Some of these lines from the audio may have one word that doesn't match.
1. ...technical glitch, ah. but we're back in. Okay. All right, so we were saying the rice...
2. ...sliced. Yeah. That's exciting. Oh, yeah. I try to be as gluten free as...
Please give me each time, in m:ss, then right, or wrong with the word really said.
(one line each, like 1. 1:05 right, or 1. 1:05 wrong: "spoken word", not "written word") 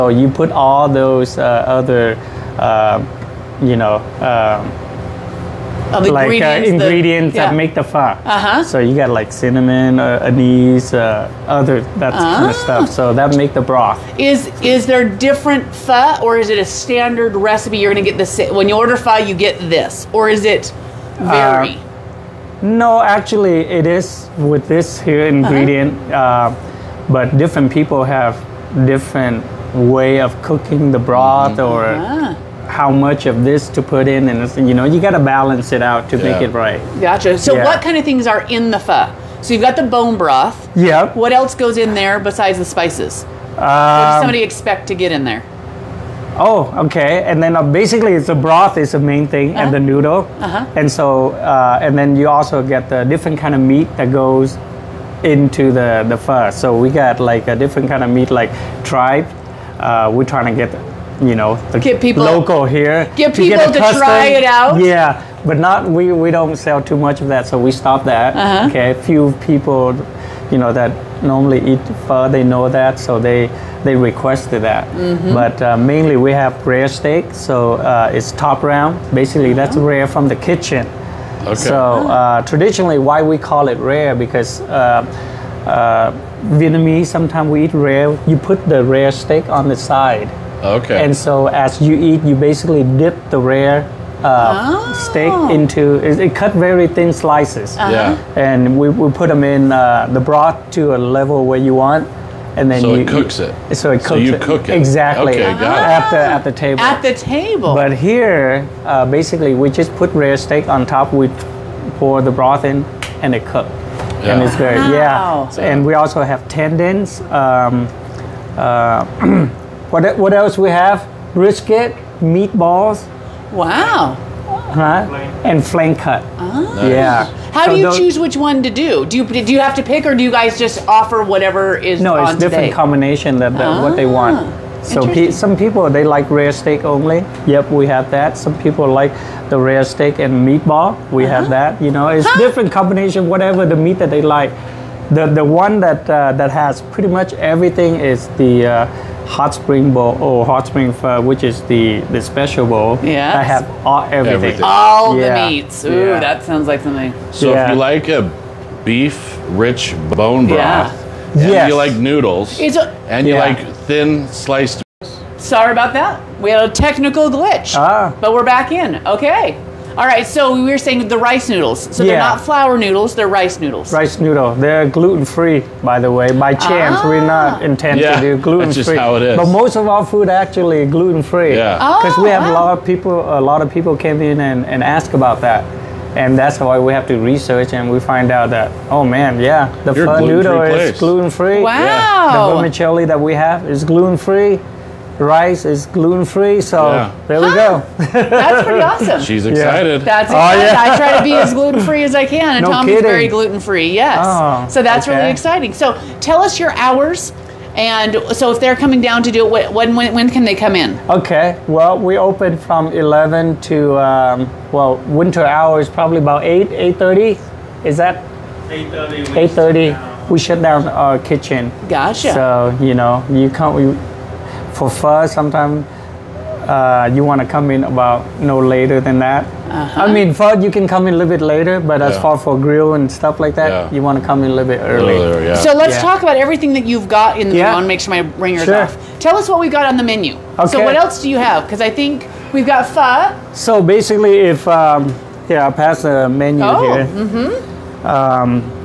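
1. 2:46 right
2. 3:19 wrong: "excited", not "sliced".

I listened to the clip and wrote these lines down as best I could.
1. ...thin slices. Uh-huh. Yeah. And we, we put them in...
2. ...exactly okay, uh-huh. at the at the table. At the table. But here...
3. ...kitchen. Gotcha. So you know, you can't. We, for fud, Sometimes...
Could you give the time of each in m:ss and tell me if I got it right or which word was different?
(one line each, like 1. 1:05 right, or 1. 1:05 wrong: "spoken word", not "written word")
1. 1:36 right
2. 1:44 right
3. 3:41 right.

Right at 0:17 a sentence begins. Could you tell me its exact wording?
You're gonna get this when you order pho, you get this, or is it uh, vary?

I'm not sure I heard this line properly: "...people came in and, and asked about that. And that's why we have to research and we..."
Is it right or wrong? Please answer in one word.
right.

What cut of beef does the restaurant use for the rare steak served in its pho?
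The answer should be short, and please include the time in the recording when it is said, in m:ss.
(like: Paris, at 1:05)
top round, at 1:18.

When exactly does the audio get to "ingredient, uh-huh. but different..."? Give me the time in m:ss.
0:25.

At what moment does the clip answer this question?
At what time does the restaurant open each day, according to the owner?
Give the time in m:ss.
3:32.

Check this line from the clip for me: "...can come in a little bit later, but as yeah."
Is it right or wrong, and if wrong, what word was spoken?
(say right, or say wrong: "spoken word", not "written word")
right.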